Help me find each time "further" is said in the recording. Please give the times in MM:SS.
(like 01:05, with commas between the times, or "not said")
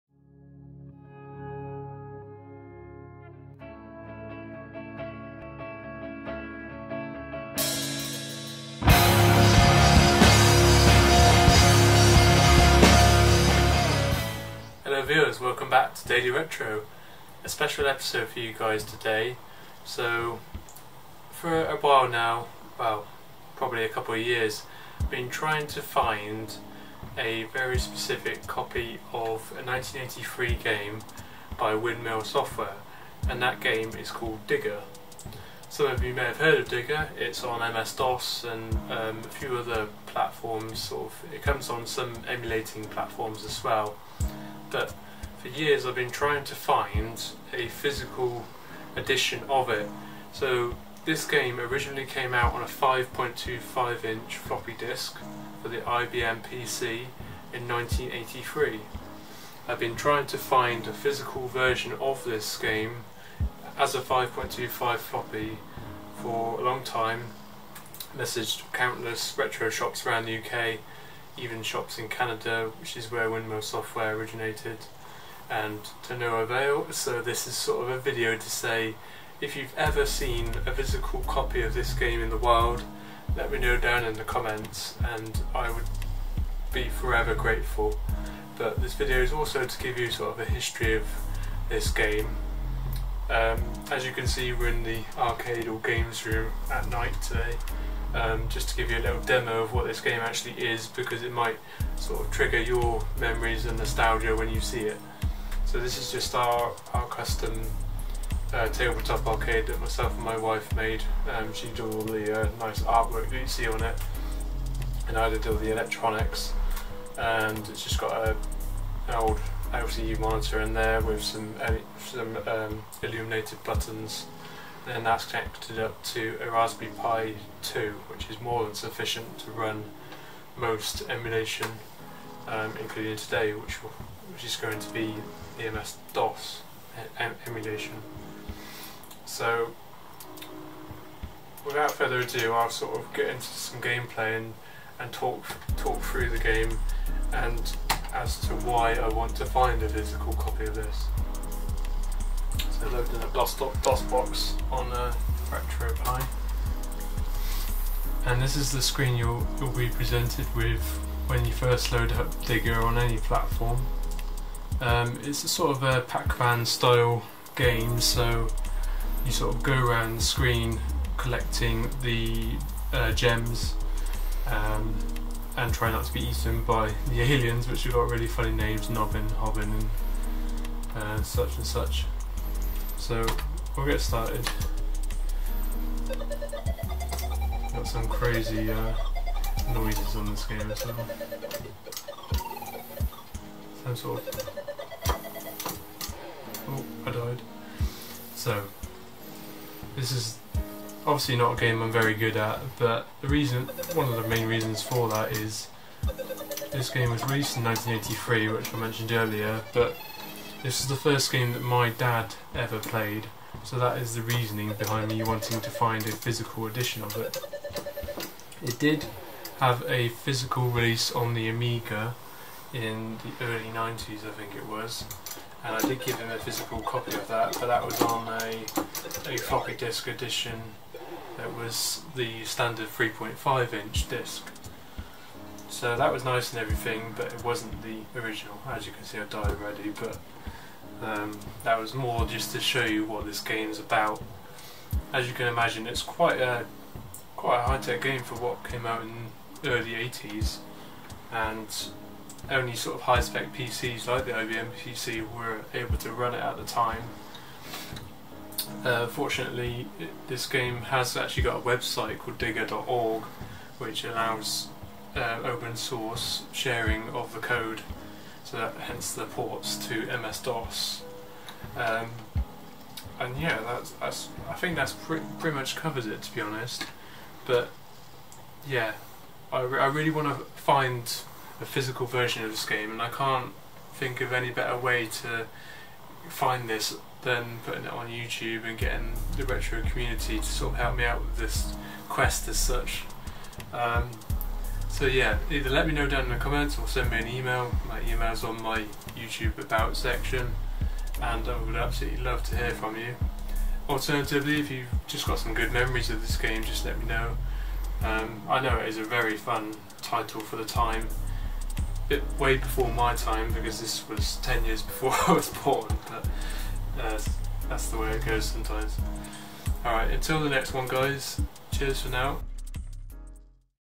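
02:21.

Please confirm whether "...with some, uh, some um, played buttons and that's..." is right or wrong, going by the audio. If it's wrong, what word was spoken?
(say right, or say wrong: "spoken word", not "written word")
wrong: "illuminated", not "played".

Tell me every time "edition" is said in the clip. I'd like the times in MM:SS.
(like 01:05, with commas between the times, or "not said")
00:48, 03:36, 03:50.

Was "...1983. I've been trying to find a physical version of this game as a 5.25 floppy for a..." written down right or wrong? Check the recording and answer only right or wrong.
right.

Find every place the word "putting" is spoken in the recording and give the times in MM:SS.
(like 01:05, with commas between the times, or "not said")
04:47.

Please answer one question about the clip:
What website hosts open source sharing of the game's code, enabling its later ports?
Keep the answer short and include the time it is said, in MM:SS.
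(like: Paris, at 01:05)
digger.org, at 04:22.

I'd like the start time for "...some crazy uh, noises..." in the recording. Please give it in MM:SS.
03:07.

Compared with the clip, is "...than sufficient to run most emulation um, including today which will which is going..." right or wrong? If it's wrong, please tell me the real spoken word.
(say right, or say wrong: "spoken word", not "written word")
right.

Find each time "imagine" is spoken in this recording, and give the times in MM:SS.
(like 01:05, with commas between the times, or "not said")
04:05.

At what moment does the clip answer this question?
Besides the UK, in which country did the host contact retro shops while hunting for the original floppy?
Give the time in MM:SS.
01:12.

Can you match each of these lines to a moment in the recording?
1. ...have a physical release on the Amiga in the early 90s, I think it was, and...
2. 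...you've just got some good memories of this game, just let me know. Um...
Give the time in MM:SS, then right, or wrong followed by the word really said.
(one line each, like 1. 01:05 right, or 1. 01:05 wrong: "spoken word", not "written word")
1. 03:39 right
2. 05:04 right.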